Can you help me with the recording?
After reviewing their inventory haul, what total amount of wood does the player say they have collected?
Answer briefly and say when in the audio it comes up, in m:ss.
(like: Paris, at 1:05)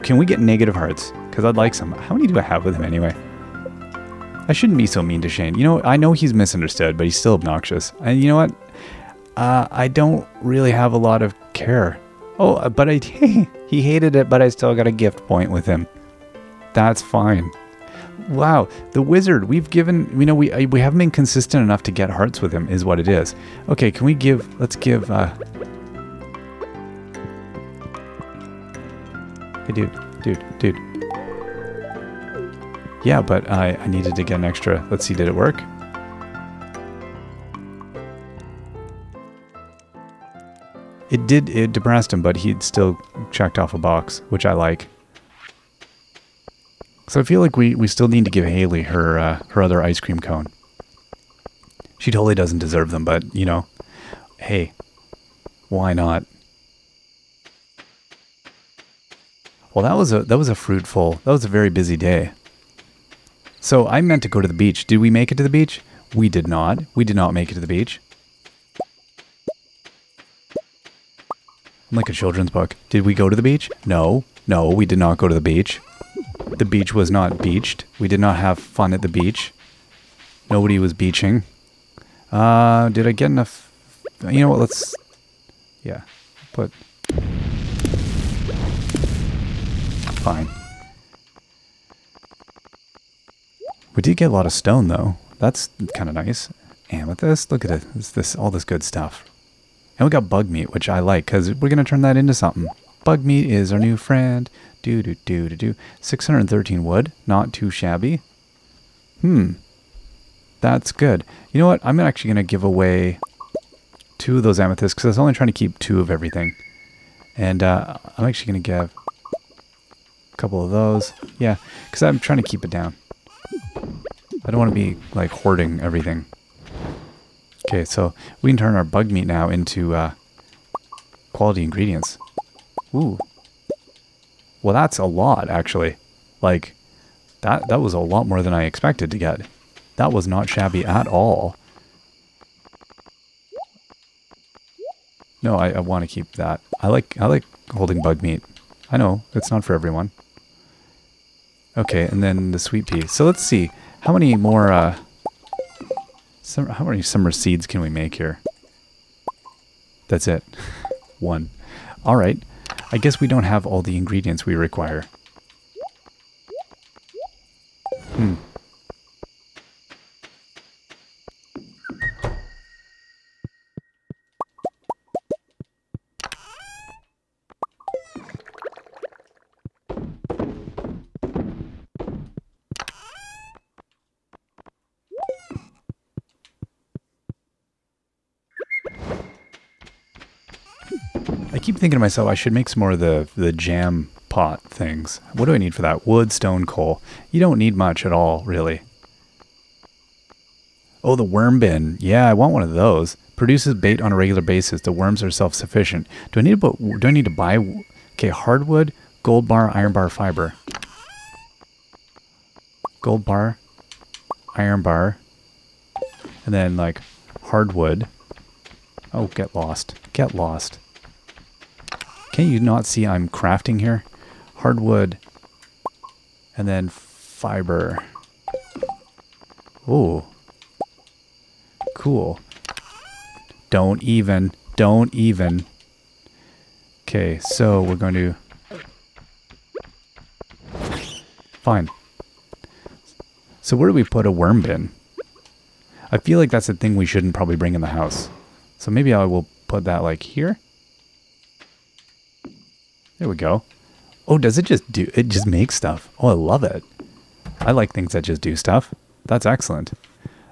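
613, at 1:45.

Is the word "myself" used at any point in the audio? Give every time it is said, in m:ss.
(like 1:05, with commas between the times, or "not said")
3:11.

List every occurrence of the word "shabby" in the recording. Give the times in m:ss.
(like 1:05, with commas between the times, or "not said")
1:47, 2:20.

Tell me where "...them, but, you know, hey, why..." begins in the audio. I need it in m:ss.
0:52.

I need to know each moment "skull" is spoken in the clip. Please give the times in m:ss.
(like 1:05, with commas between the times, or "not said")
not said.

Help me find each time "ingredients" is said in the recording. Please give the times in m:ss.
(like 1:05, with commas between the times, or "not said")
2:11, 2:43.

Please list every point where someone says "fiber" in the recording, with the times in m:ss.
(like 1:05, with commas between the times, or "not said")
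3:30, 3:46.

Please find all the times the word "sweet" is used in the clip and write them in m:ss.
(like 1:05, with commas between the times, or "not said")
2:32.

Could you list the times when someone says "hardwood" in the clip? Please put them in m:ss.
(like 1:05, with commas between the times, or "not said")
3:28, 3:37, 3:44.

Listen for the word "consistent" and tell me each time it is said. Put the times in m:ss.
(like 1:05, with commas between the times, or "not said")
0:21.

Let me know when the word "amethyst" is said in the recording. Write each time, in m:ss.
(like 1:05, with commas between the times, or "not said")
1:36, 1:54.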